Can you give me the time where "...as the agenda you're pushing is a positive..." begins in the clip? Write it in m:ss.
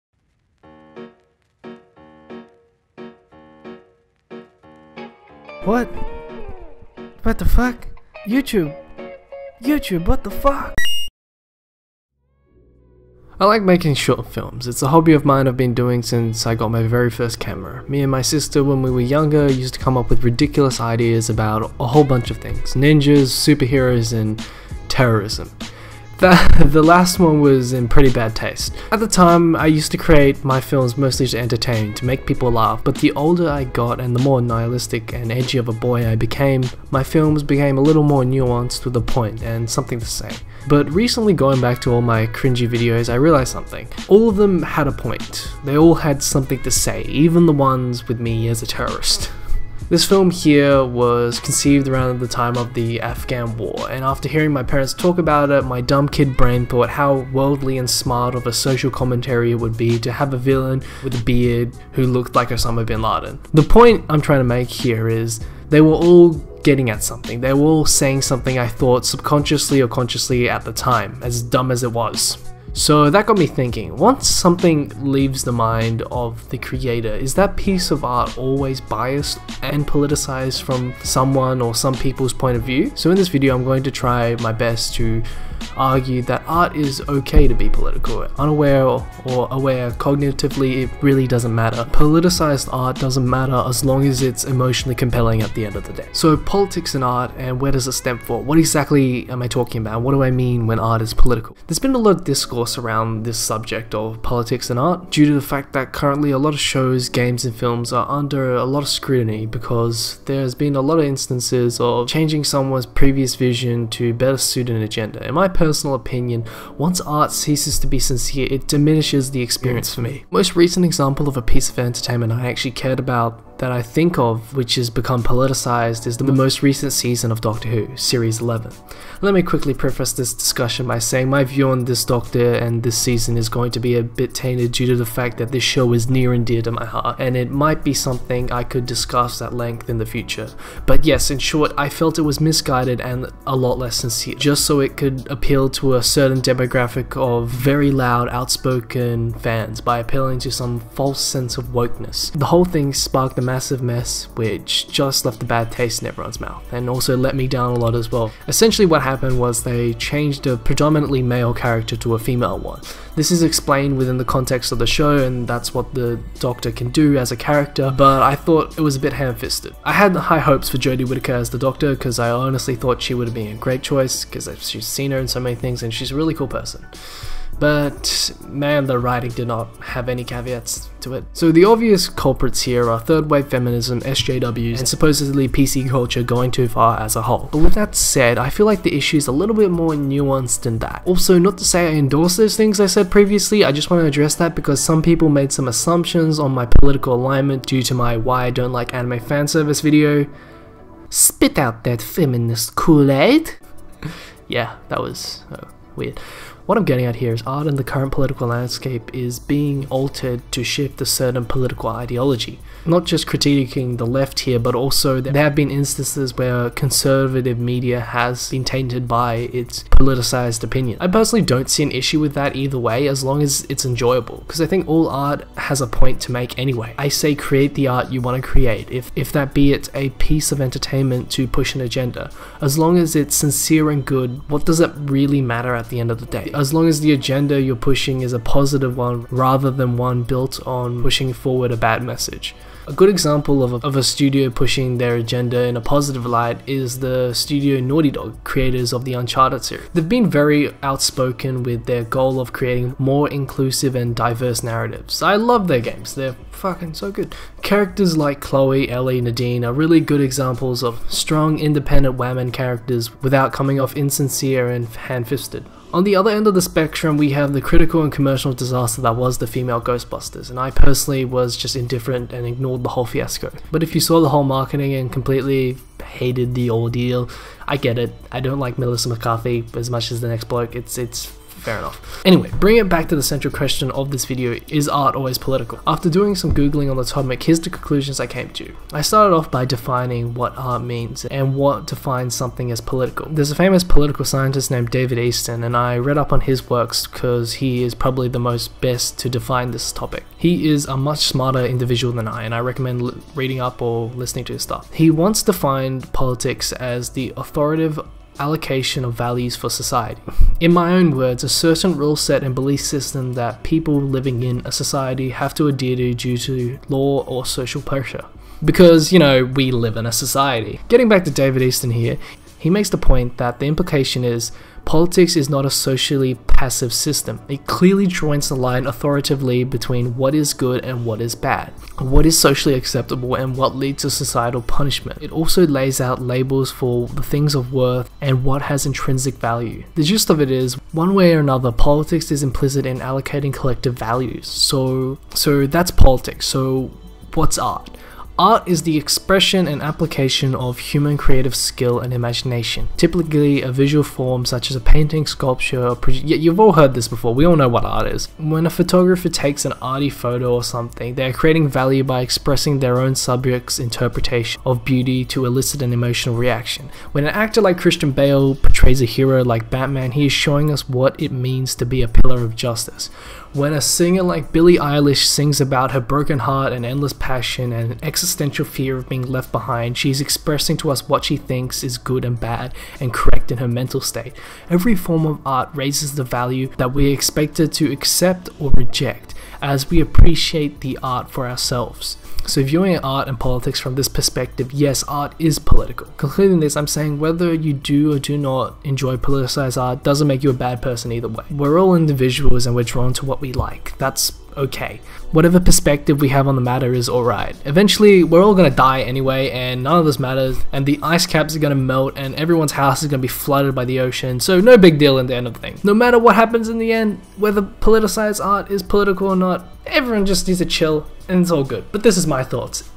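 3:56.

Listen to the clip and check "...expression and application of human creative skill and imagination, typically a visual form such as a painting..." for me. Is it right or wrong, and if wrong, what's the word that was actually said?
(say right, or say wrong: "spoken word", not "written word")
right.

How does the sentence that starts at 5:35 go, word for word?
It also lays out labels for the things of worth and what has intrinsic value.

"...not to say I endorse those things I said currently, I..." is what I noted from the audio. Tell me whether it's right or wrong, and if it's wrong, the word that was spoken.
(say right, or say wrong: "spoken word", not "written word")
wrong: "previously", not "currently".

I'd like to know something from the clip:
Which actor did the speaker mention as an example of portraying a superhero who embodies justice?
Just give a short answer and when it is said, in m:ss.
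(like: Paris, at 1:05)
Christian Bale, at 6:07.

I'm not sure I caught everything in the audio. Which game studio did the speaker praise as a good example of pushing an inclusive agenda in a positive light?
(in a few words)
Naughty Dog.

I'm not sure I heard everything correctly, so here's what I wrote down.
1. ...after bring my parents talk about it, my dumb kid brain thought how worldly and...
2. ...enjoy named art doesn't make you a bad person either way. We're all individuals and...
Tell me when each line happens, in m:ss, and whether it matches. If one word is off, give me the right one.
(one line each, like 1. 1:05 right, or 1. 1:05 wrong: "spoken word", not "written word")
1. 0:54 wrong: "hearing", not "bring"
2. 6:38 wrong: "politicized", not "named".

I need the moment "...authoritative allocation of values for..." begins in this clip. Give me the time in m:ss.
5:07.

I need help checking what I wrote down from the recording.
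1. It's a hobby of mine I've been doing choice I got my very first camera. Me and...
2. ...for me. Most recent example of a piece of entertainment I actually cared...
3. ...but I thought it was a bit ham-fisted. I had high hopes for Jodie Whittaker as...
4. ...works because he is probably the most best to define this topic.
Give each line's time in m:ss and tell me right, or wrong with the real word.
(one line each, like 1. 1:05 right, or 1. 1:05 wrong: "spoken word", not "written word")
1. 0:14 wrong: "since", not "choice"
2. 1:59 right
3. 2:48 right
4. 4:56 right.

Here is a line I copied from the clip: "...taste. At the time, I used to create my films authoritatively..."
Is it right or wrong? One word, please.
wrong.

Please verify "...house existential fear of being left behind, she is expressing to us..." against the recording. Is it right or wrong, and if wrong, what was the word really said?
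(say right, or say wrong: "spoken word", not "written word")
wrong: "exercise", not "house".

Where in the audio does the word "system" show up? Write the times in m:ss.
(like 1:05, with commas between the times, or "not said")
5:12, 5:26.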